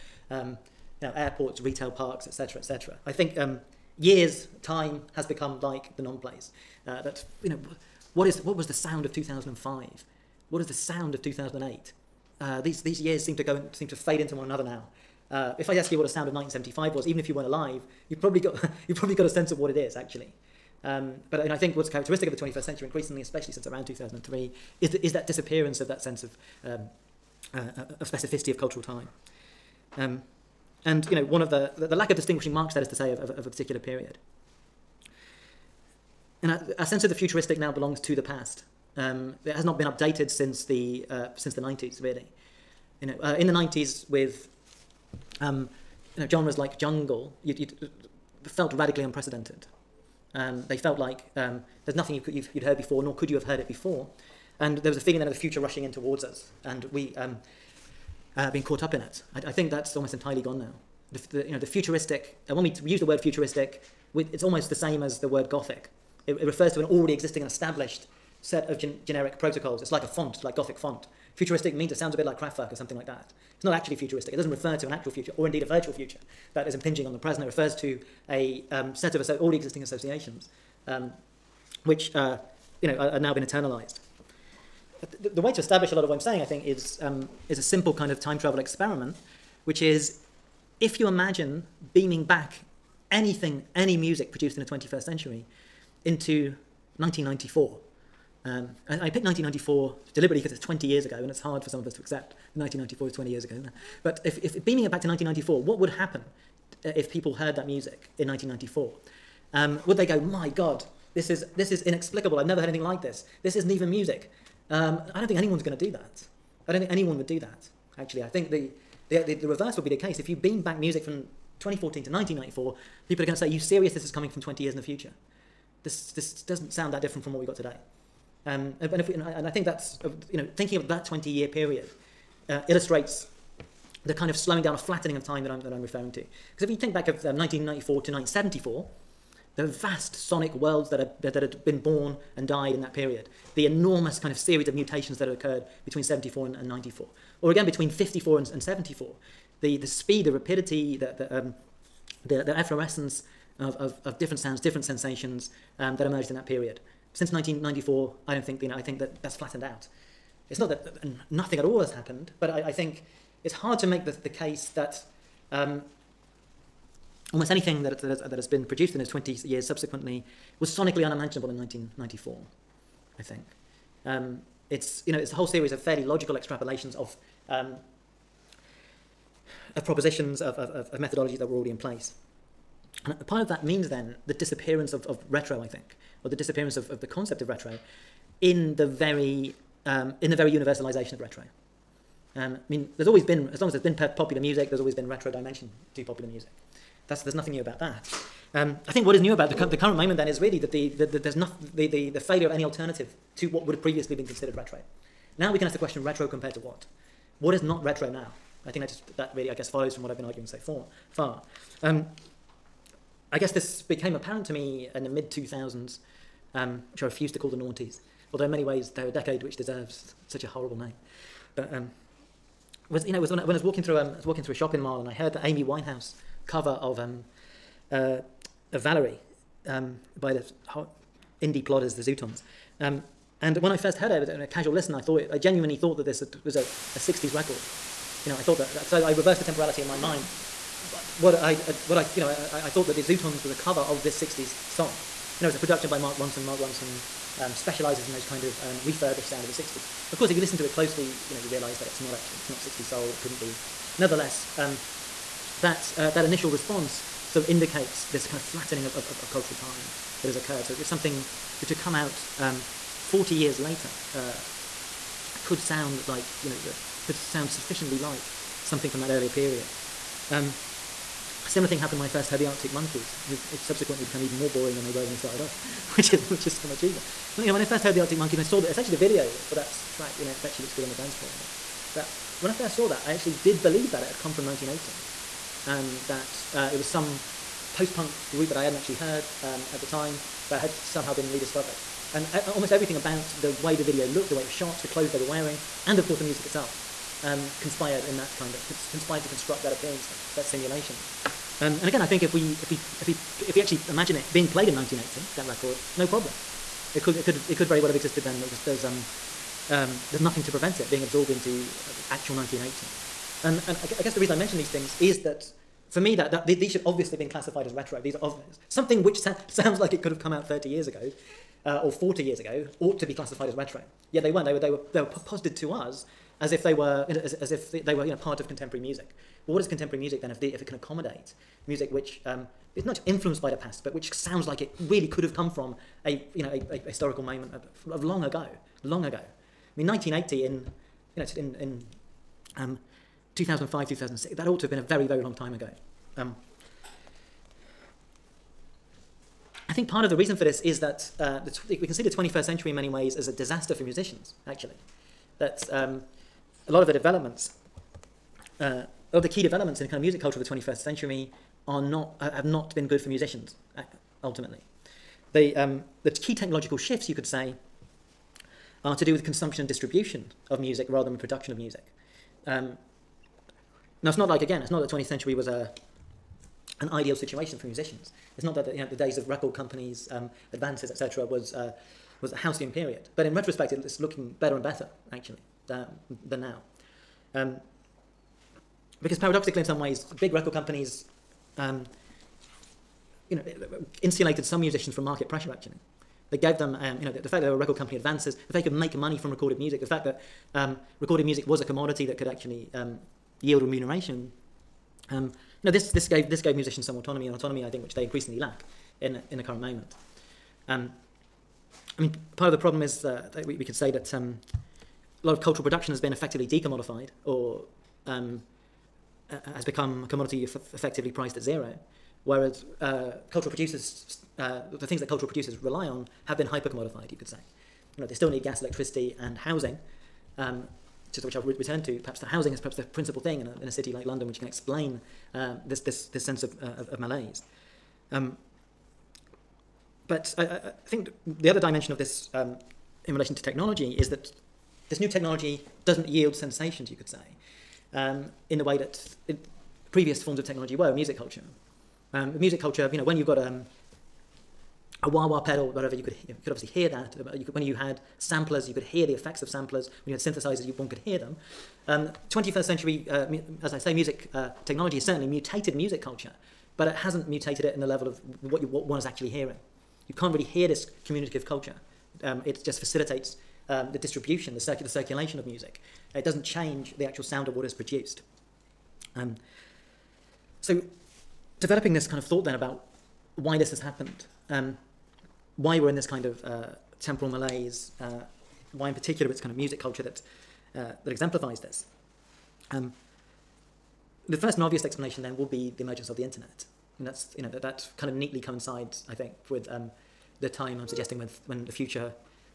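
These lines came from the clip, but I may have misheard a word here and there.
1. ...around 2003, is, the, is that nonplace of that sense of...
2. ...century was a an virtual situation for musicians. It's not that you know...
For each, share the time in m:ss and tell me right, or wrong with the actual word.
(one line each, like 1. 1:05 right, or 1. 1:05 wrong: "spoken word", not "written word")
1. 0:23 wrong: "disappearance", not "nonplace"
2. 6:15 wrong: "ideal", not "virtual".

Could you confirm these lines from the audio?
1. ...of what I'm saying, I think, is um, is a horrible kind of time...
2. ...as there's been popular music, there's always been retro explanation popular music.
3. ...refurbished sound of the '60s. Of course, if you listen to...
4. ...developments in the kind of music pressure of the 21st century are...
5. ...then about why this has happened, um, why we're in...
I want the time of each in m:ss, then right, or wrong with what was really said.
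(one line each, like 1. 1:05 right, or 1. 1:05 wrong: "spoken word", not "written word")
1. 1:26 wrong: "simple", not "horrible"
2. 3:13 wrong: "dimension", not "explanation"
3. 4:08 right
4. 5:59 wrong: "culture", not "pressure"
5. 8:02 right.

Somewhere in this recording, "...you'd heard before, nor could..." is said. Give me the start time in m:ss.
0:52.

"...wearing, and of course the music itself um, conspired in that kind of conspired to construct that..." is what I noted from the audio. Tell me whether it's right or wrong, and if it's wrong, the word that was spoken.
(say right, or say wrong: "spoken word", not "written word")
right.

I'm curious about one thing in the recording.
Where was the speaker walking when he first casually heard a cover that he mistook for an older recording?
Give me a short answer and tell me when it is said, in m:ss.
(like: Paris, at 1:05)
a shopping mall, at 3:44.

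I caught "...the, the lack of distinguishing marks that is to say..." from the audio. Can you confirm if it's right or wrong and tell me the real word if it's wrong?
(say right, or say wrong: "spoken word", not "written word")
right.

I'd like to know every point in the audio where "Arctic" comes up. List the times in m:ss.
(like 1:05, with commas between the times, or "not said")
4:32, 4:37.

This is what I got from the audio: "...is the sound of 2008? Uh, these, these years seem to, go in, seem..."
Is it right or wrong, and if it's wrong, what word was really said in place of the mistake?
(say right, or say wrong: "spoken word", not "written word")
right.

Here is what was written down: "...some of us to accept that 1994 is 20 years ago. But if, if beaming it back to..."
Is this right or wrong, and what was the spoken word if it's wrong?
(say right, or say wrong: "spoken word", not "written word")
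right.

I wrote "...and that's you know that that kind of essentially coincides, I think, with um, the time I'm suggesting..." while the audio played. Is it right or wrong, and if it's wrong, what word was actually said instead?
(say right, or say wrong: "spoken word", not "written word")
wrong: "neatly", not "essentially".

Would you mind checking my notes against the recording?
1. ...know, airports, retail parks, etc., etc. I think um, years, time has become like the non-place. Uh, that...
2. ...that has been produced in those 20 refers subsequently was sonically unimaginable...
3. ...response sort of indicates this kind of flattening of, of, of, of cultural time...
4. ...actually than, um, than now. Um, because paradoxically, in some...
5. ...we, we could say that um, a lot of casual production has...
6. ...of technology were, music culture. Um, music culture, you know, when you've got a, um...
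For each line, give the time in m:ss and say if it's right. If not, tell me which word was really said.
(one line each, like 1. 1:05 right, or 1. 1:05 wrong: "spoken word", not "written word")
1. 0:01 right
2. 2:48 wrong: "years", not "refers"
3. 4:16 right
4. 6:25 right
5. 6:53 wrong: "cultural", not "casual"
6. 7:30 right.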